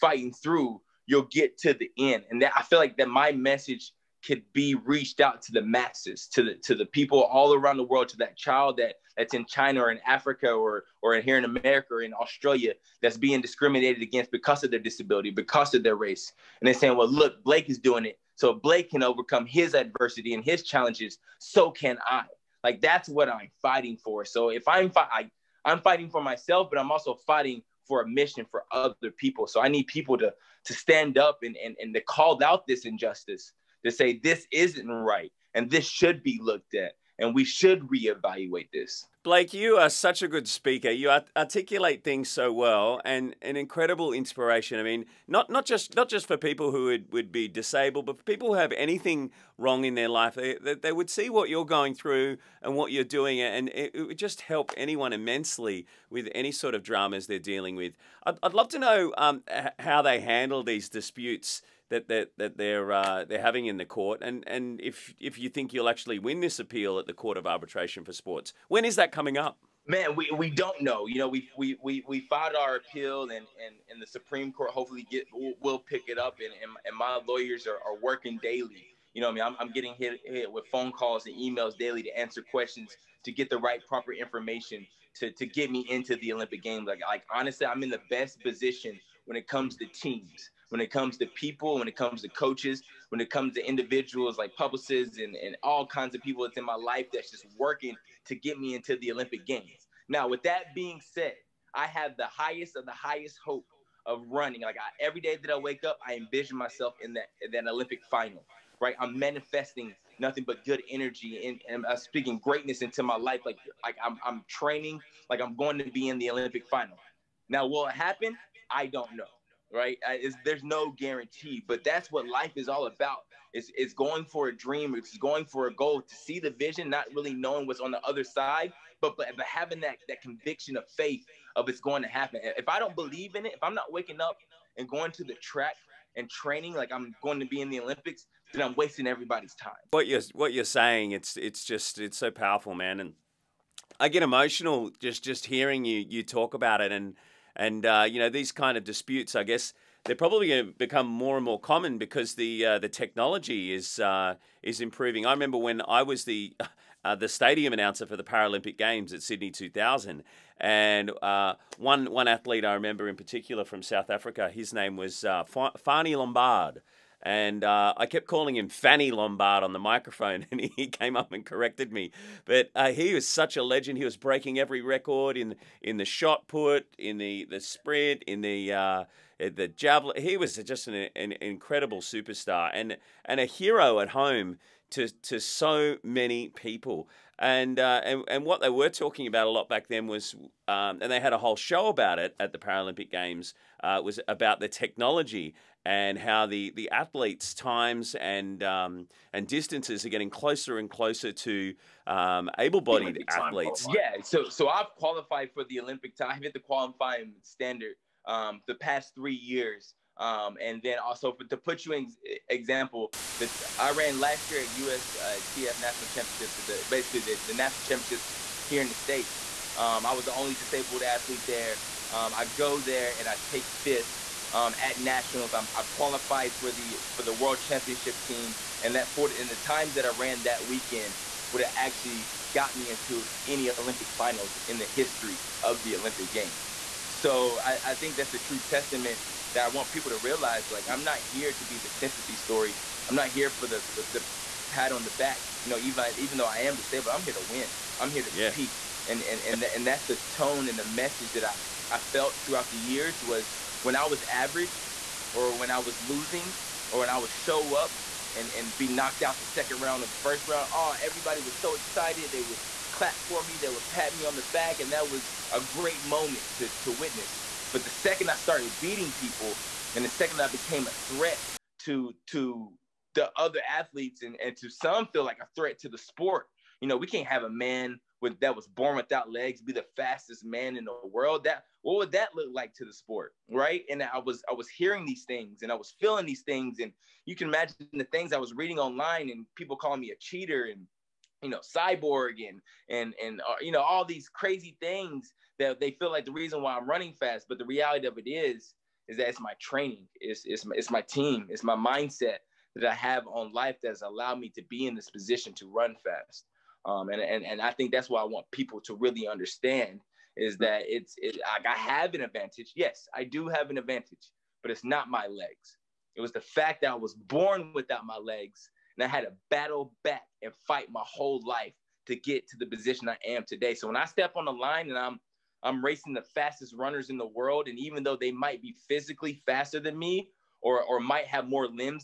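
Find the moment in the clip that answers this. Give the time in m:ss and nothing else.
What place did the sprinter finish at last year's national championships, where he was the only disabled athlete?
3:43.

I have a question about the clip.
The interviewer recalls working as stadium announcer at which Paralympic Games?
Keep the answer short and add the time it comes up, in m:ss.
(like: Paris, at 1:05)
Sydney 2000, at 2:39.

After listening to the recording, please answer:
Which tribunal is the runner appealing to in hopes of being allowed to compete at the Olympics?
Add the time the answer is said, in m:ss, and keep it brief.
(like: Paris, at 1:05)
Court of Arbitration for Sports, at 1:07.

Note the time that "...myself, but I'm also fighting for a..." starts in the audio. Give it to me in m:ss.
0:26.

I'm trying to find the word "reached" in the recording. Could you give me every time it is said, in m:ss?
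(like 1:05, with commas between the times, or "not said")
0:04.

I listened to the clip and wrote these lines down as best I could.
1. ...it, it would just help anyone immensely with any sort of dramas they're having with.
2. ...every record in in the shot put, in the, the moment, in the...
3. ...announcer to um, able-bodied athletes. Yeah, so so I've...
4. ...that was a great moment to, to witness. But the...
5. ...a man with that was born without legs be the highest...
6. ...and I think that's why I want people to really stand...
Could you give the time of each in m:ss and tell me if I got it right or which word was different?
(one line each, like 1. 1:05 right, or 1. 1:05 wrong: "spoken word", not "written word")
1. 0:53 wrong: "dealing", not "having"
2. 2:54 wrong: "sprint", not "moment"
3. 3:20 wrong: "closer", not "announcer"
4. 4:24 right
5. 4:37 wrong: "fastest", not "highest"
6. 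5:07 wrong: "understand", not "stand".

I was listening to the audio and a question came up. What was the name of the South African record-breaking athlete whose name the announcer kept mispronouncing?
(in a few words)
Fanie Lombaard.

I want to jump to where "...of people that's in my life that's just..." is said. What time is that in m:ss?
1:36.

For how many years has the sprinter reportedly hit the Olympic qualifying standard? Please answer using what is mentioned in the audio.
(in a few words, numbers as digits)
3.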